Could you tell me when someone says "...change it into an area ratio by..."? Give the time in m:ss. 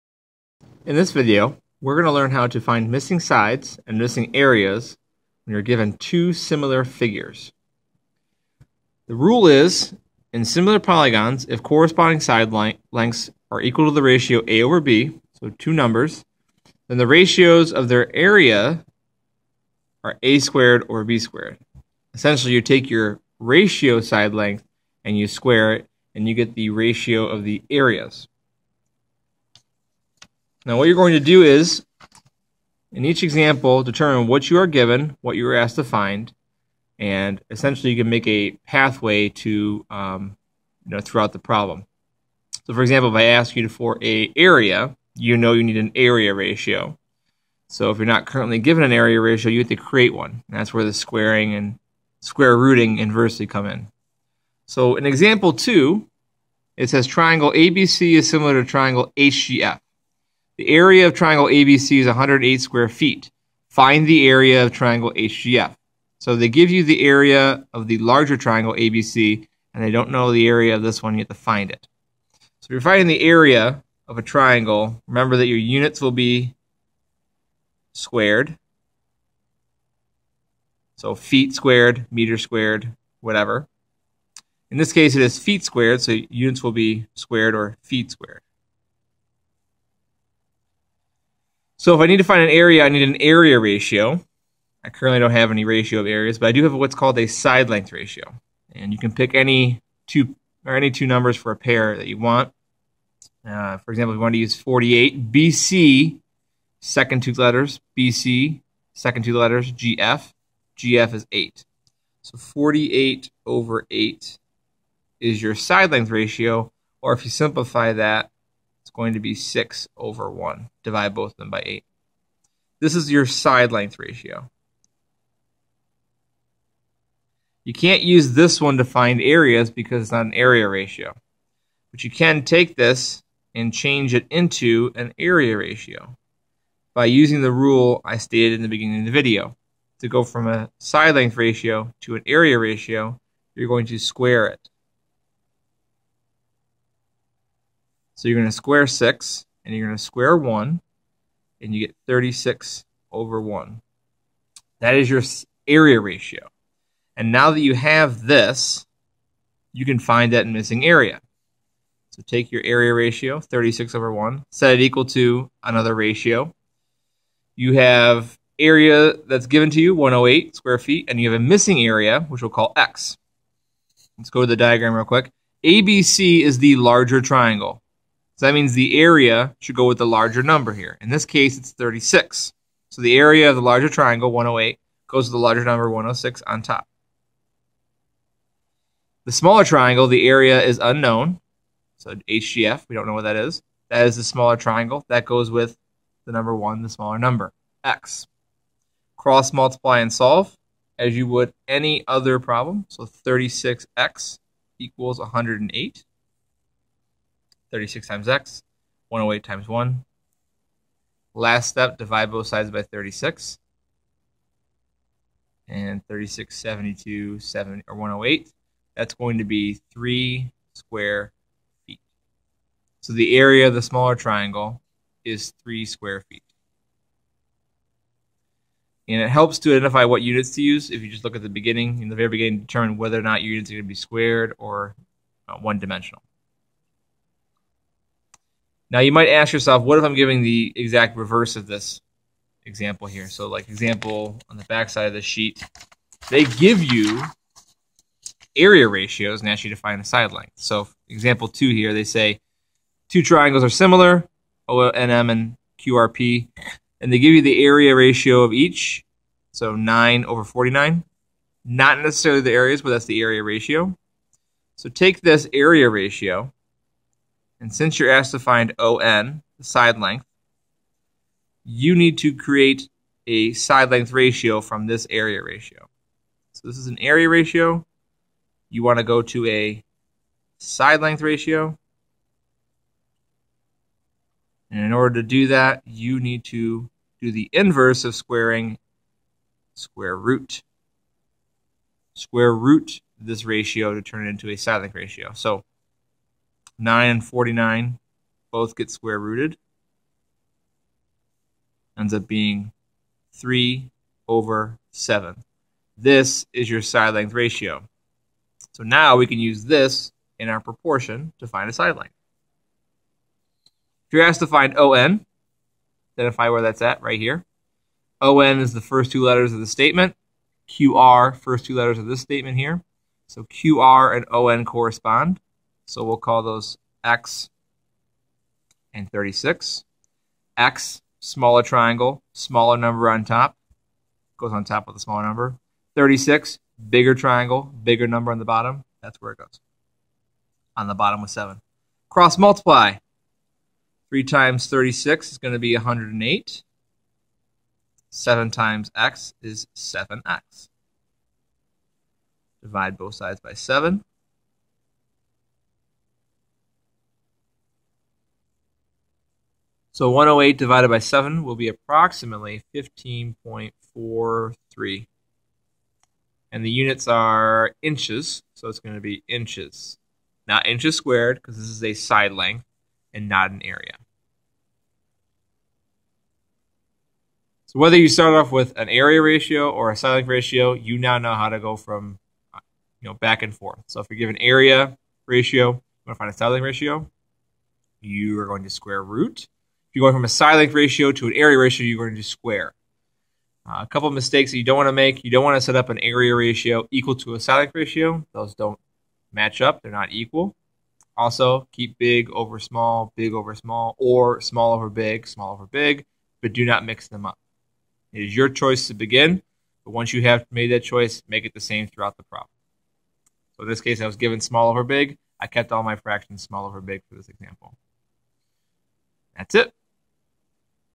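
2:13.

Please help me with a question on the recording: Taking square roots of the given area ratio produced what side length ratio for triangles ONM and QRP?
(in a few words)
3 over 7.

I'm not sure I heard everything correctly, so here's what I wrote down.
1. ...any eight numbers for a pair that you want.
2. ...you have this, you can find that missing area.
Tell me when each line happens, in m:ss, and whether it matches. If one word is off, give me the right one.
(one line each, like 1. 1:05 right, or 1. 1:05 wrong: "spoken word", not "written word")
1. 1:40 wrong: "two", not "eight"
2. 2:37 right.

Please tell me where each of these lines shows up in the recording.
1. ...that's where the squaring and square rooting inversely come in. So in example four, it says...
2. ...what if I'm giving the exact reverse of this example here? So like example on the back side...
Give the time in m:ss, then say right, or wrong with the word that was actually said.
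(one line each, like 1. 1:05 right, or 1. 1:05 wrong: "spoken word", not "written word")
1. 0:50 wrong: "two", not "four"
2. 3:59 right.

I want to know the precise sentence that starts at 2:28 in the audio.
So you're going to square 6, and you're going to square 1, and you get 36 over 1.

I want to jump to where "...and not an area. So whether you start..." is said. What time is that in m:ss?
6:13.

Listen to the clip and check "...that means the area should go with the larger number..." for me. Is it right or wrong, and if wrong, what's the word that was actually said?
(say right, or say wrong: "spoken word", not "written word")
right.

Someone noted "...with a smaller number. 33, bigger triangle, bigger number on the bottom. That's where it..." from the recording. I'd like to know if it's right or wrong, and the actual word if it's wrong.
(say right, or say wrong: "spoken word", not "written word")
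wrong: "36", not "33".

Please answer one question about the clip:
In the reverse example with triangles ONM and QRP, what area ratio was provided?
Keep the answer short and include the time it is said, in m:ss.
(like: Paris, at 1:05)
9 over 49, at 4:19.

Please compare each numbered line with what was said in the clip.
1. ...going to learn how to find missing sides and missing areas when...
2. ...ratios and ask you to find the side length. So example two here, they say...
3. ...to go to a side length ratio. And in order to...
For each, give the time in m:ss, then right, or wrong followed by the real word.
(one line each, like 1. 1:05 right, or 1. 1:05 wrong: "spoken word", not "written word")
1. 0:01 right
2. 4:08 right
3. 4:38 right.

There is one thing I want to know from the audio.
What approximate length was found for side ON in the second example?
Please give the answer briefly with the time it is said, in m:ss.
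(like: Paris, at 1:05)
15.43 inches, at 6:02.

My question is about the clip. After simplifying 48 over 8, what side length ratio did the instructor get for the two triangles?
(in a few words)
6 over 1.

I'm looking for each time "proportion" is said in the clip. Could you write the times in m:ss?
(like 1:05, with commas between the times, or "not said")
5:10.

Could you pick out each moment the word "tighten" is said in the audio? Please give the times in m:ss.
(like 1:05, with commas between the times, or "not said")
not said.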